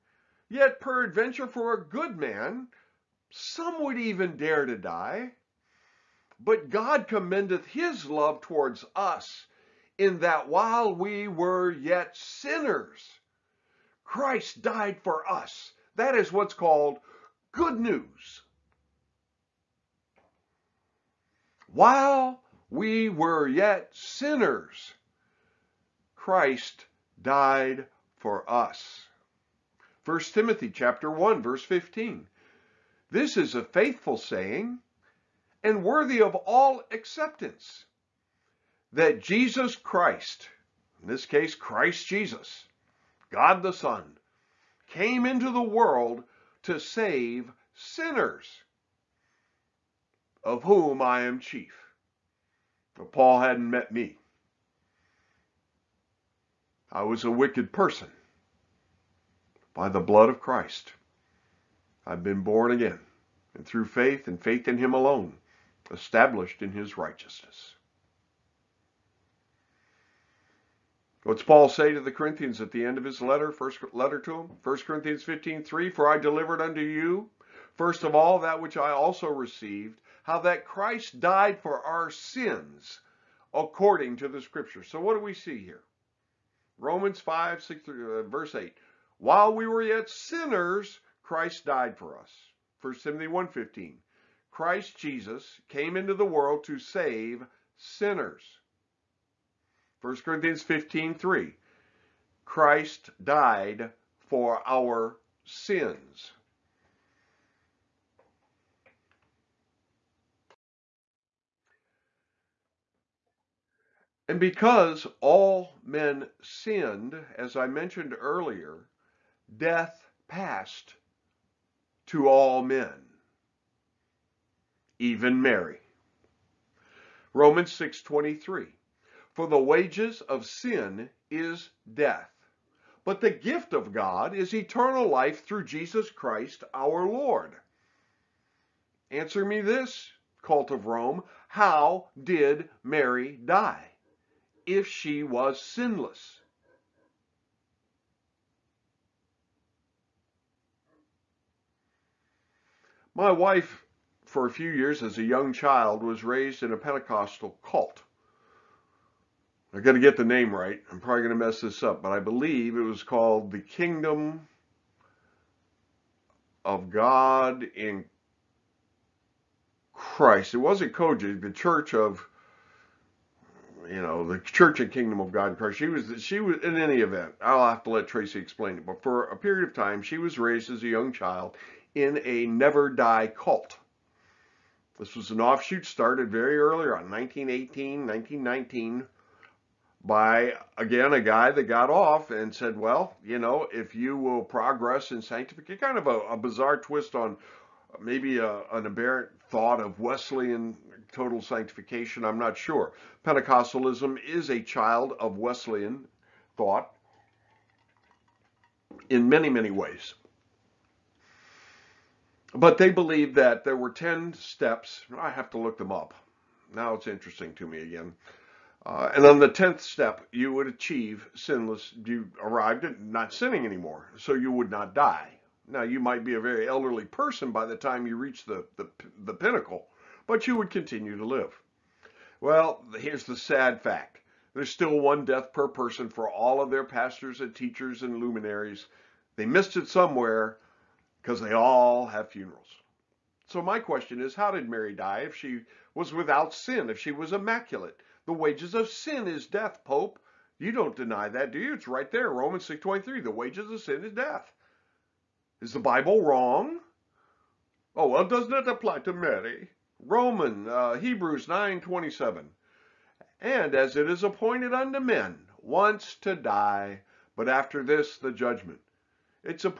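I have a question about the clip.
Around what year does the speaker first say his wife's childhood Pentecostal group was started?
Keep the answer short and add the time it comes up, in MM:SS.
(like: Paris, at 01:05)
1918, at 03:07.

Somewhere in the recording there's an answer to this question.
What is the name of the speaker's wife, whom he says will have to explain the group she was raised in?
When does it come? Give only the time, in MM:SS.
02:58.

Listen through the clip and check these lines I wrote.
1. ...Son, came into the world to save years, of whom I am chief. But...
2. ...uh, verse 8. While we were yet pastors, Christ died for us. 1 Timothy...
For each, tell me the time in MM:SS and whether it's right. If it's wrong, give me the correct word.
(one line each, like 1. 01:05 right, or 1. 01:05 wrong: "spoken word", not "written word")
1. 00:43 wrong: "sinners", not "years"
2. 01:27 wrong: "sinners", not "pastors".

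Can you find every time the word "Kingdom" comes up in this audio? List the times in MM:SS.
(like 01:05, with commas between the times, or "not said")
02:43, 02:54.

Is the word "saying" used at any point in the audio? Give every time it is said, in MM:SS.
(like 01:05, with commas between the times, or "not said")
00:34.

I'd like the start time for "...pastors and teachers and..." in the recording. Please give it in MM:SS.
03:56.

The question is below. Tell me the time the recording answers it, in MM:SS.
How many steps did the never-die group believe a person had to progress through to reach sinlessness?
03:33.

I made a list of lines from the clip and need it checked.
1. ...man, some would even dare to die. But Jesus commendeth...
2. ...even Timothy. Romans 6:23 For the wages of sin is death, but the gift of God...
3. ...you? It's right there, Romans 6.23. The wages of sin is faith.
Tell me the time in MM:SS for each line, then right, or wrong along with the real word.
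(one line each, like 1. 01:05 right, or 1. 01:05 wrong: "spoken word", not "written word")
1. 00:02 wrong: "God", not "Jesus"
2. 02:04 wrong: "Mary", not "Timothy"
3. 04:11 wrong: "death", not "faith".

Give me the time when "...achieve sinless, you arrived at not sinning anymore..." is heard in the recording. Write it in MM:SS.
03:40.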